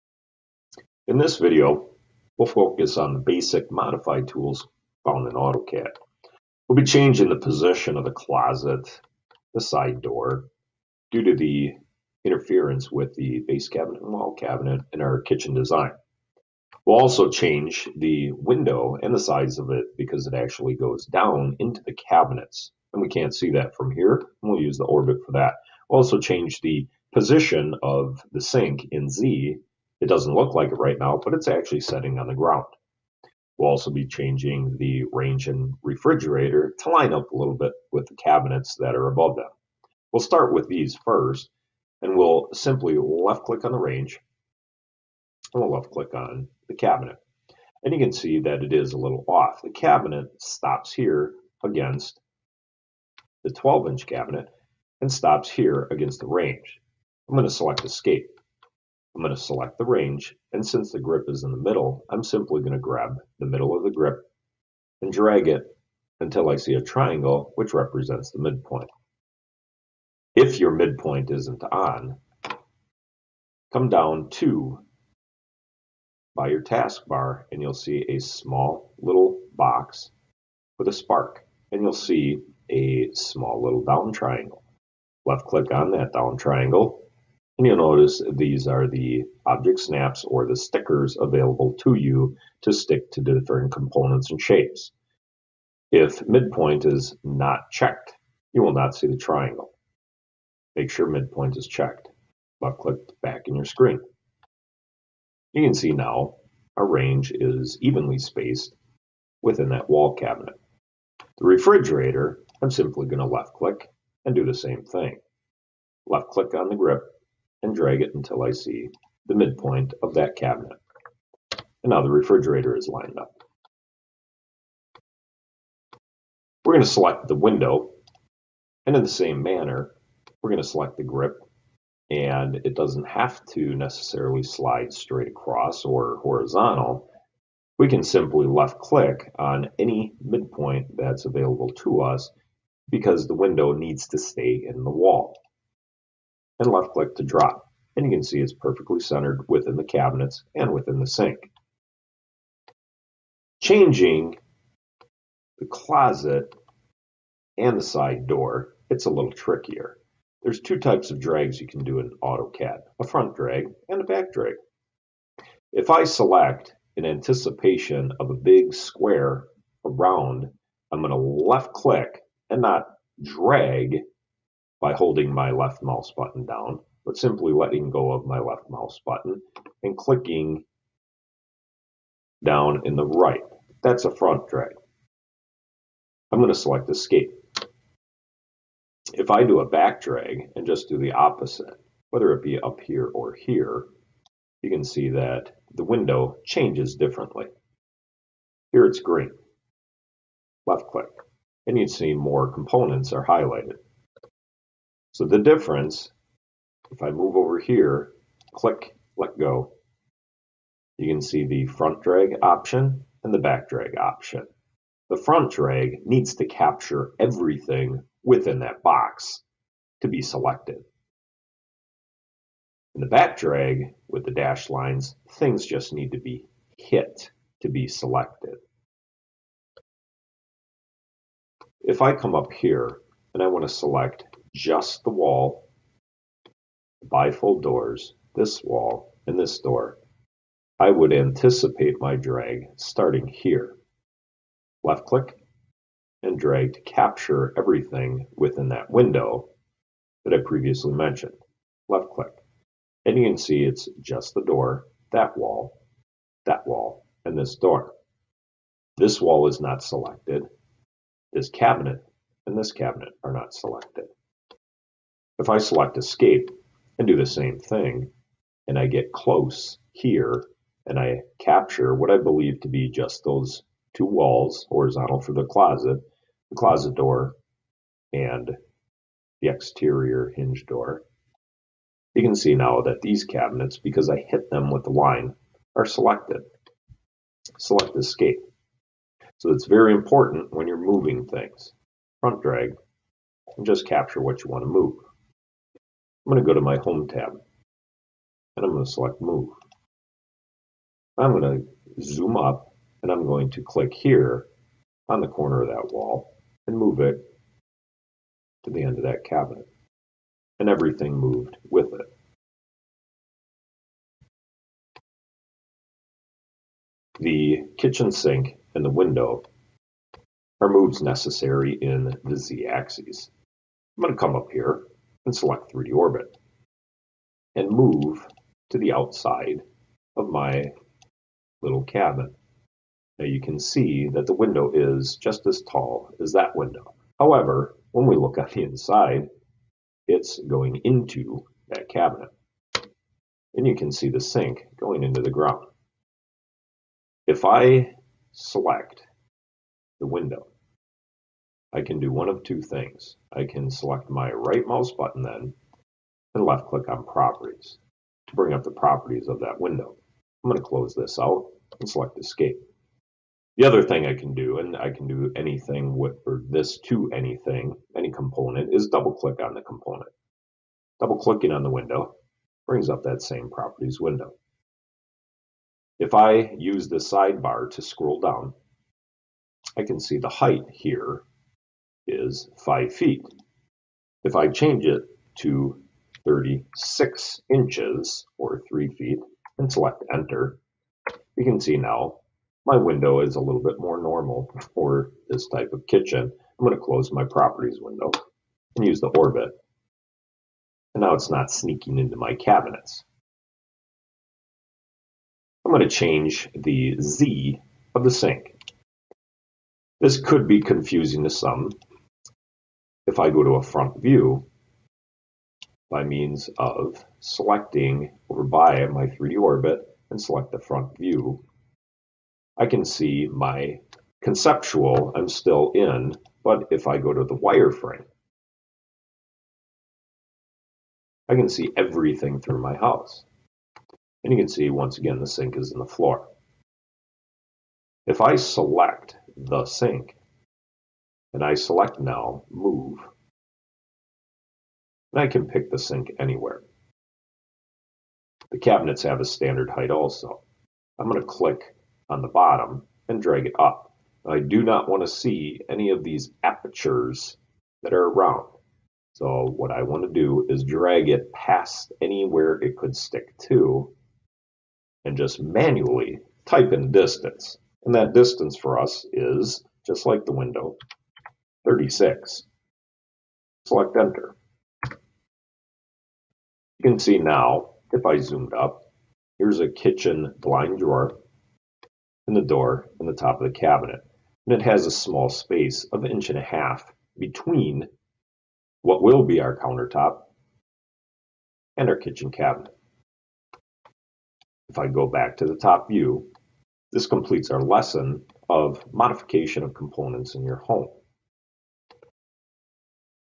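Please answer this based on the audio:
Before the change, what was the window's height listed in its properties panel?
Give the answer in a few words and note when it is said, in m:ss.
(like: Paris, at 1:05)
5 feet, at 6:22.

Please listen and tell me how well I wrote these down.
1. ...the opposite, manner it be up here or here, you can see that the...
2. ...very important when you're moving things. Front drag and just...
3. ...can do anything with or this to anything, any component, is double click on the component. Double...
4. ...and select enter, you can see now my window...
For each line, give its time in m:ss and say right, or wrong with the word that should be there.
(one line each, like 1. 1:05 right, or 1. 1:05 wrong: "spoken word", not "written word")
1. 3:10 wrong: "whether", not "manner"
2. 4:49 right
3. 6:04 right
4. 6:29 right.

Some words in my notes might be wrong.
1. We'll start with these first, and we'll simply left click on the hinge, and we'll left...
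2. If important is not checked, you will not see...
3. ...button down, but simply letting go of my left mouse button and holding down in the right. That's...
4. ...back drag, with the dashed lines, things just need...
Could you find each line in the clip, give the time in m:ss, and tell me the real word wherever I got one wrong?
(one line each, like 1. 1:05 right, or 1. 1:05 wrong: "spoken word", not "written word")
1. 0:40 wrong: "range", not "hinge"
2. 1:35 wrong: "midpoint", not "important"
3. 2:56 wrong: "clicking", not "holding"
4. 3:43 right.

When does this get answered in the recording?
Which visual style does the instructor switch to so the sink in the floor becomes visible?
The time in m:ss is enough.
7:07.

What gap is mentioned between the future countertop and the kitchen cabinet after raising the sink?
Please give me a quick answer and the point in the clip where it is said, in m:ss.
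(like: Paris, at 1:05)
1.5 inches, at 8:06.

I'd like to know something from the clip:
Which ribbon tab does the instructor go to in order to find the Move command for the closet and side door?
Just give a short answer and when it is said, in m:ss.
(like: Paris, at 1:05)
Home tab, at 4:56.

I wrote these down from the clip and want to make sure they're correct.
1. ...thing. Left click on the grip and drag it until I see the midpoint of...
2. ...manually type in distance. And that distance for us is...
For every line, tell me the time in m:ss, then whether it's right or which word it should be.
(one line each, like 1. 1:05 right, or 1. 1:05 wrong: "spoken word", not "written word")
1. 1:54 right
2. 7:45 right.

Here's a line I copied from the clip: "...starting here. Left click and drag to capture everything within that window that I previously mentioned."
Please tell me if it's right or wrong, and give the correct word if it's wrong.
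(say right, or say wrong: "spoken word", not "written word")
right.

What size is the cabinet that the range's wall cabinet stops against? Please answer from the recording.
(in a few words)
12 inch.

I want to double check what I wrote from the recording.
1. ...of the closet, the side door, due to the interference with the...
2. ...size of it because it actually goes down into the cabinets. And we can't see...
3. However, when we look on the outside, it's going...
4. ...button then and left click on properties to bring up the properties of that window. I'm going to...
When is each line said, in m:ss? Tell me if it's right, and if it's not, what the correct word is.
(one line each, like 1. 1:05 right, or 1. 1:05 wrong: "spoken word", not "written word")
1. 0:07 right
2. 0:19 right
3. 5:37 wrong: "inside", not "outside"
4. 5:54 right.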